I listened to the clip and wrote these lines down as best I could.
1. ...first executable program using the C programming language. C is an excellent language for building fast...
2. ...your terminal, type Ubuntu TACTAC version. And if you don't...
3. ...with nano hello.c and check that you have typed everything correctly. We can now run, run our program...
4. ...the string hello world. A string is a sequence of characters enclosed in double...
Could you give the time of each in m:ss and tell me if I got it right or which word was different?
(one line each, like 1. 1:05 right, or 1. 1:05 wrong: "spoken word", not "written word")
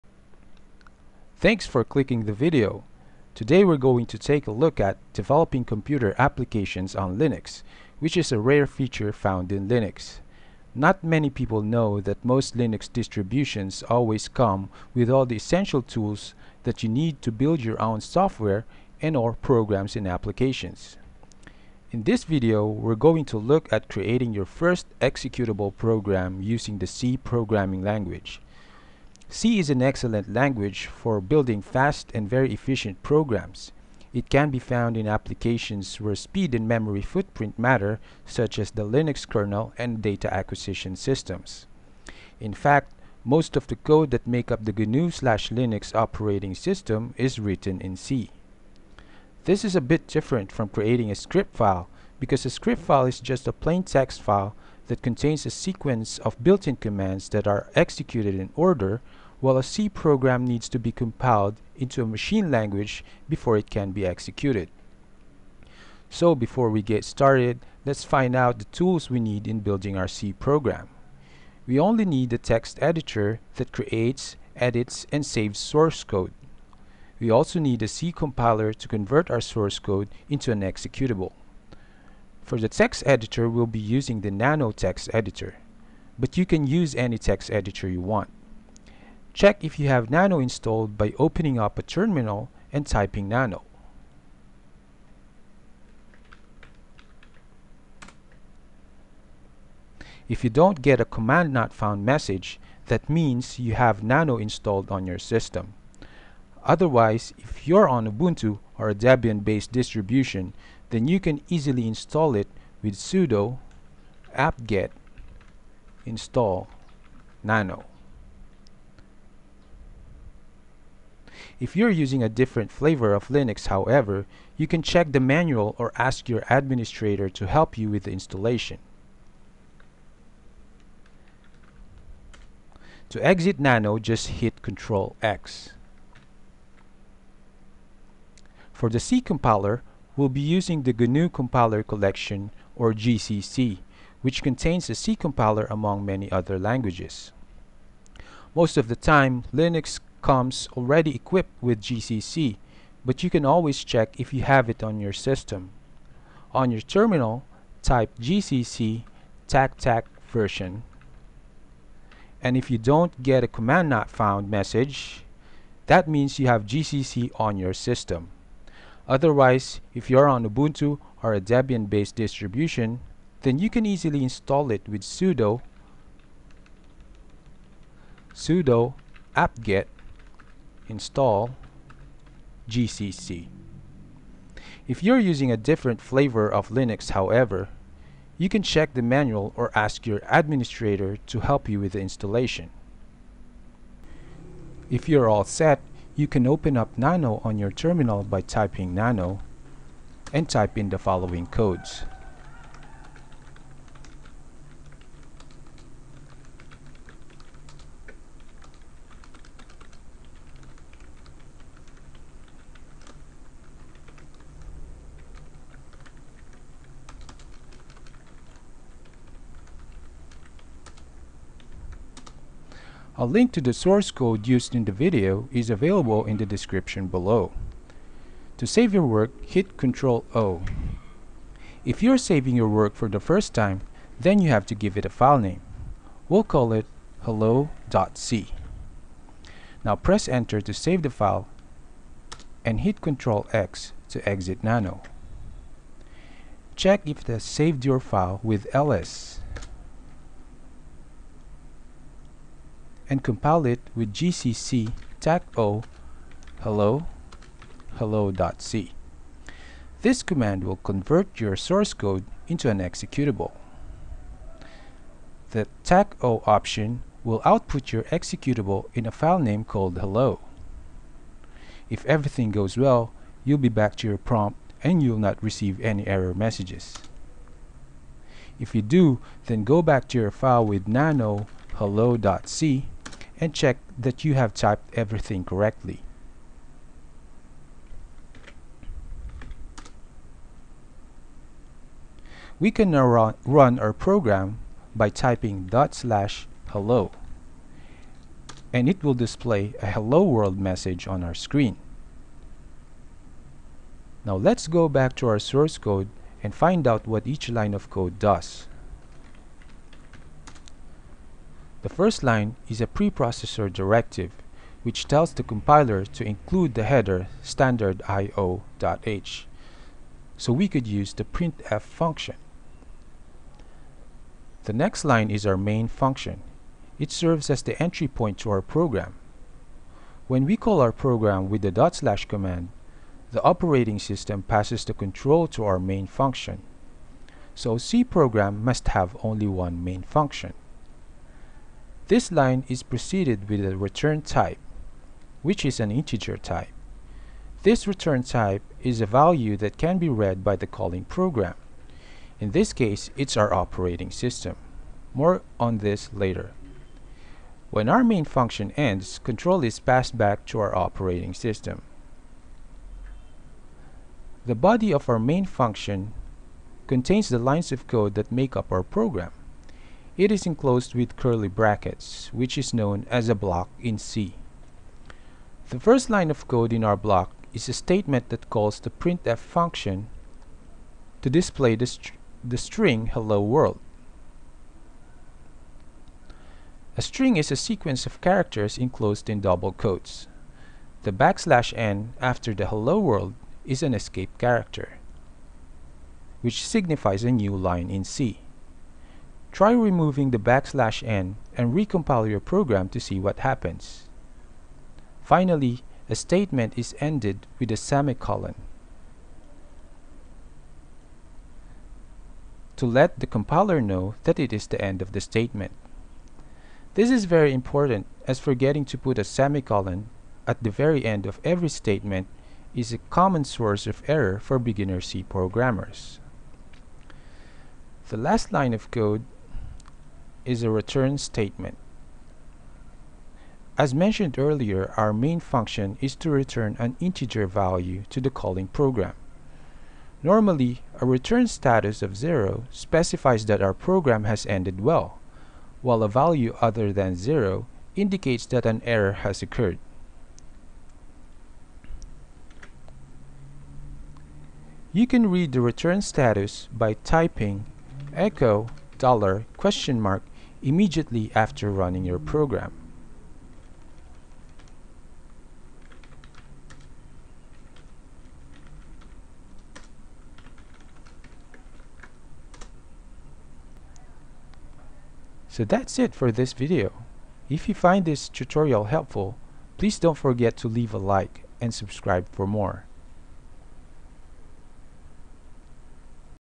1. 0:24 right
2. 2:36 wrong: "GCC", not "Ubuntu"
3. 4:40 right
4. 6:22 right.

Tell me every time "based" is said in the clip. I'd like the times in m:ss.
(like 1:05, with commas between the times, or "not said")
1:48, 2:51.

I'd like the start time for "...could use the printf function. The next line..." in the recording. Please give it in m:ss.
5:20.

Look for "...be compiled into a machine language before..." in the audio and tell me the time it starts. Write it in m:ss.
1:00.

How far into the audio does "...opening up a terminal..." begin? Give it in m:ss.
1:31.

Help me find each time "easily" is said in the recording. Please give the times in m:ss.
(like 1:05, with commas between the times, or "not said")
1:51, 2:53.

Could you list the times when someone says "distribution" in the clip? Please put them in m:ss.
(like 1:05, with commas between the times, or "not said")
0:12, 1:49, 2:52.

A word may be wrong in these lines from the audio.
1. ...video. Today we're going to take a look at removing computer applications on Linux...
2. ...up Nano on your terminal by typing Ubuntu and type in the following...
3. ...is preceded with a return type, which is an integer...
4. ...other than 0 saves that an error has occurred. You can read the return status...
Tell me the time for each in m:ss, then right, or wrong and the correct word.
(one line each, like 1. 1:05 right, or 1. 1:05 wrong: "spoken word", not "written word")
1. 0:02 wrong: "developing", not "removing"
2. 3:16 wrong: "Nano", not "Ubuntu"
3. 5:42 right
4. 7:26 wrong: "indicates", not "saves".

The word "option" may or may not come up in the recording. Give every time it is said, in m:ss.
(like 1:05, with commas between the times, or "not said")
4:26.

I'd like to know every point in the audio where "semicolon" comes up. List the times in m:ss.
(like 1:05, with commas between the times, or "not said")
6:47, 6:59.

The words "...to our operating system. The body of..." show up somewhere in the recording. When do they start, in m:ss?
6:00.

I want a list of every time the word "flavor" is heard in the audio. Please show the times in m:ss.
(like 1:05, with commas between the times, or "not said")
2:02, 3:06.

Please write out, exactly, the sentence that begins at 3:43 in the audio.
A link to the source code used in the video is available in the description below.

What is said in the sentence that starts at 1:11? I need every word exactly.
We only need a text editor that creates, edits, and saves source code.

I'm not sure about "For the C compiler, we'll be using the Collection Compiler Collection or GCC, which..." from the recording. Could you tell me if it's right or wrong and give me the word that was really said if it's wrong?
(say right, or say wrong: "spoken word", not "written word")
wrong: "GNU", not "Collection".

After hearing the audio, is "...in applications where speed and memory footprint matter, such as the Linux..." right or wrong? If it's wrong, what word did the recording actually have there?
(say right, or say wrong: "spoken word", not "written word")
right.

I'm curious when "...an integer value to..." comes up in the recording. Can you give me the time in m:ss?
7:16.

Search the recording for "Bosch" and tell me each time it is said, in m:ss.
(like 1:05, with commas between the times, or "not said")
not said.